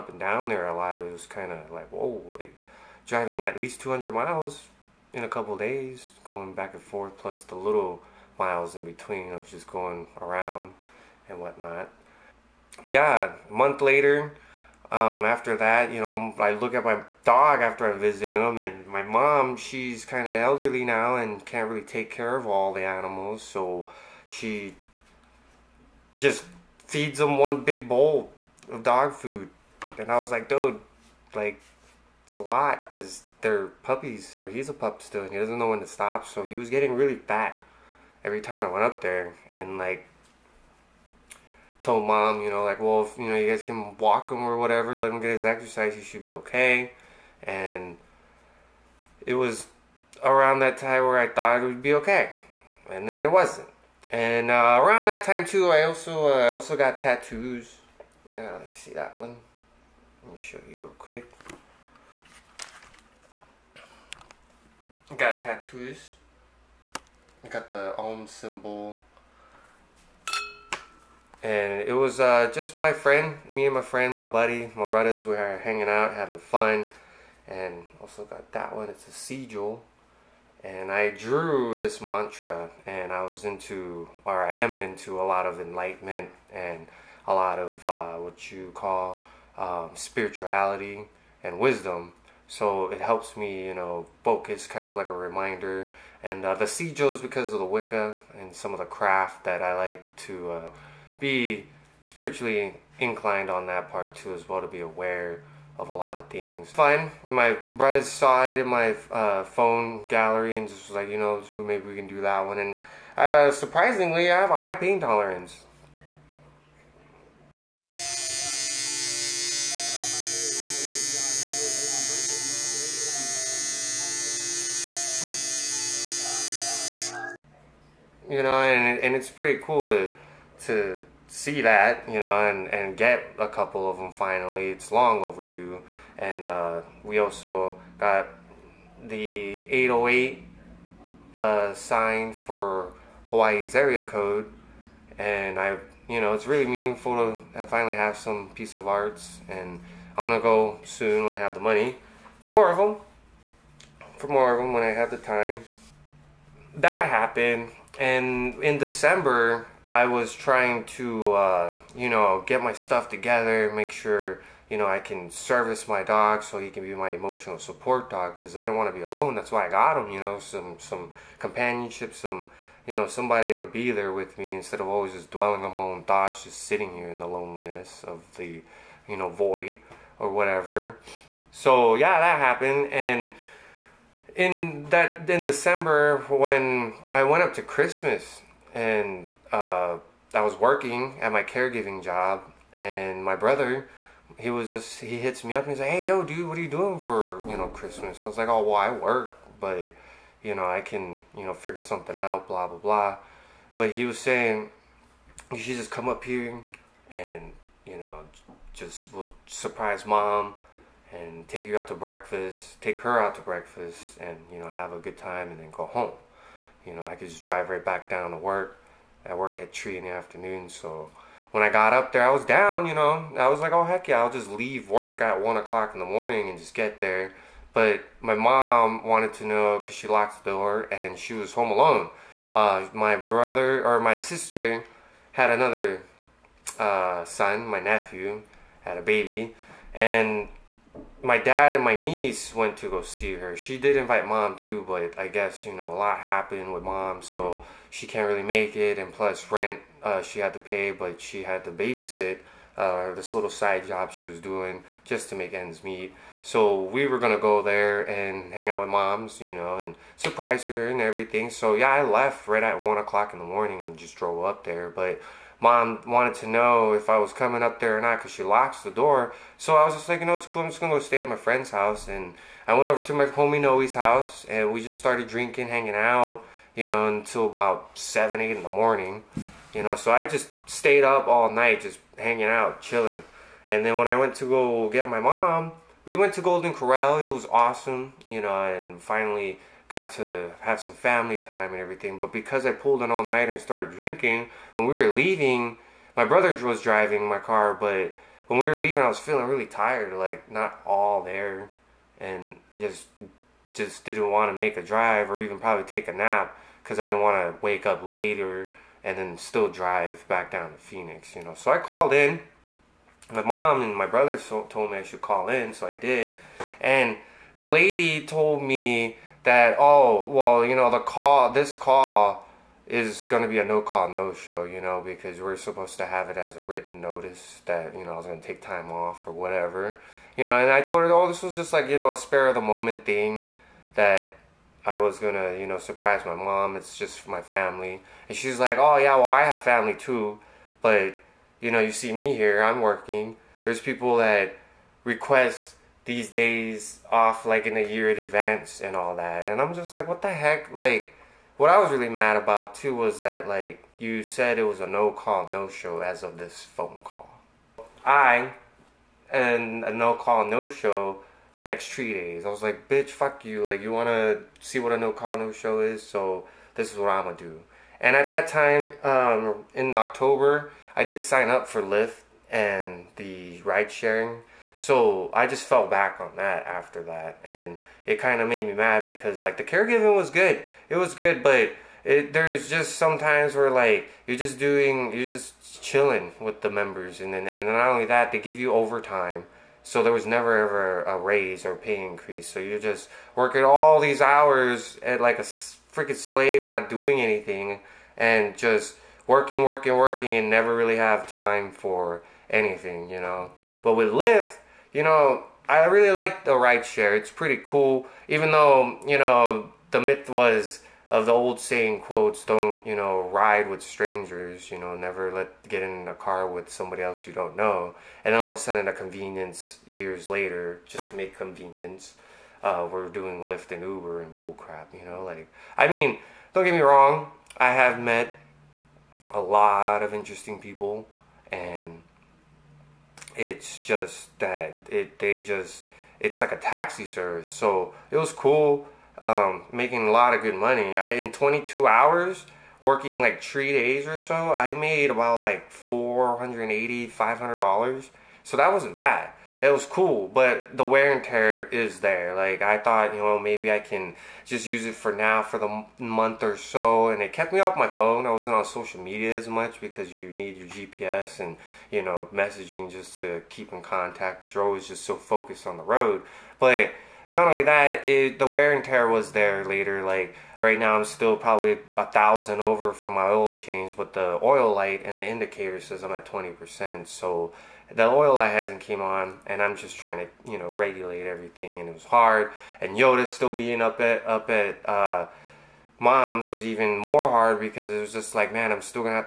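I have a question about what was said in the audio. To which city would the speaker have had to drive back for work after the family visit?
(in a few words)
Phoenix.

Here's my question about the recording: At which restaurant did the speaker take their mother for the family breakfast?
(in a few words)
Golden Corral.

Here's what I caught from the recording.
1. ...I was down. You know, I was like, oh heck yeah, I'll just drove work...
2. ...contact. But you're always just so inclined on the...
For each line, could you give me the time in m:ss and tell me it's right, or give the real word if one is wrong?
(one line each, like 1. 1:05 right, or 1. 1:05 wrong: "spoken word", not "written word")
1. 3:42 wrong: "leave", not "drove"
2. 7:43 wrong: "focused", not "inclined".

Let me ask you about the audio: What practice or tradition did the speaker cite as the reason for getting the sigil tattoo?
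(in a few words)
Wicca.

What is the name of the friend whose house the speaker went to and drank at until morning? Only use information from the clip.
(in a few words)
Noe.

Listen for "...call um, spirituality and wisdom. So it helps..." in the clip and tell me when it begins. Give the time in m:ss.
1:28.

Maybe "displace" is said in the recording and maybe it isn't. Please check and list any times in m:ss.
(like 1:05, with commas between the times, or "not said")
not said.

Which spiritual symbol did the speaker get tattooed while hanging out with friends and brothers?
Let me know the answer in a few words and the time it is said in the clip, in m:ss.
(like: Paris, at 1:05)
Om symbol, at 1:07.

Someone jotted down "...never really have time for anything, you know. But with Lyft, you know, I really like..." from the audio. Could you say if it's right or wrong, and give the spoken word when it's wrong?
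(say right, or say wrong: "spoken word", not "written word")
right.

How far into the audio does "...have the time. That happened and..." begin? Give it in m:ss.
2:34.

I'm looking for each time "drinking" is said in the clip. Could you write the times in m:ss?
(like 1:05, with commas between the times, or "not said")
4:35, 4:53.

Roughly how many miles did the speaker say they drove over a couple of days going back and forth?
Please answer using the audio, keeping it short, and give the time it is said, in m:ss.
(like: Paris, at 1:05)
200, at 0:03.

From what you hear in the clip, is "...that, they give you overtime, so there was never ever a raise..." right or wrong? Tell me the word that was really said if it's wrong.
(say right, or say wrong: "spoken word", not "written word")
right.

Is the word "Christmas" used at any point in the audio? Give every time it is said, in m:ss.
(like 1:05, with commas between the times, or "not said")
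3:07, 3:17.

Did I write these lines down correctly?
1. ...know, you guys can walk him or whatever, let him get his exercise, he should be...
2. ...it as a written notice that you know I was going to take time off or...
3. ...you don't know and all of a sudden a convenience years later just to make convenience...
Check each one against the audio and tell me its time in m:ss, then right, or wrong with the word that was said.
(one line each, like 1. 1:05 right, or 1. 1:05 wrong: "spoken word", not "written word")
1. 0:43 right
2. 5:26 right
3. 6:57 right.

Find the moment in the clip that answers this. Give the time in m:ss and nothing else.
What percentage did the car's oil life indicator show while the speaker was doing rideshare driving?
7:56.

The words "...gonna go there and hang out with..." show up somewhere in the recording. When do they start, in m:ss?
4:17.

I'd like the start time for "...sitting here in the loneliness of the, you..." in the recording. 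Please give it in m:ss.
2:56.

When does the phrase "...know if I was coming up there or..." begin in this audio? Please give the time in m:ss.
4:26.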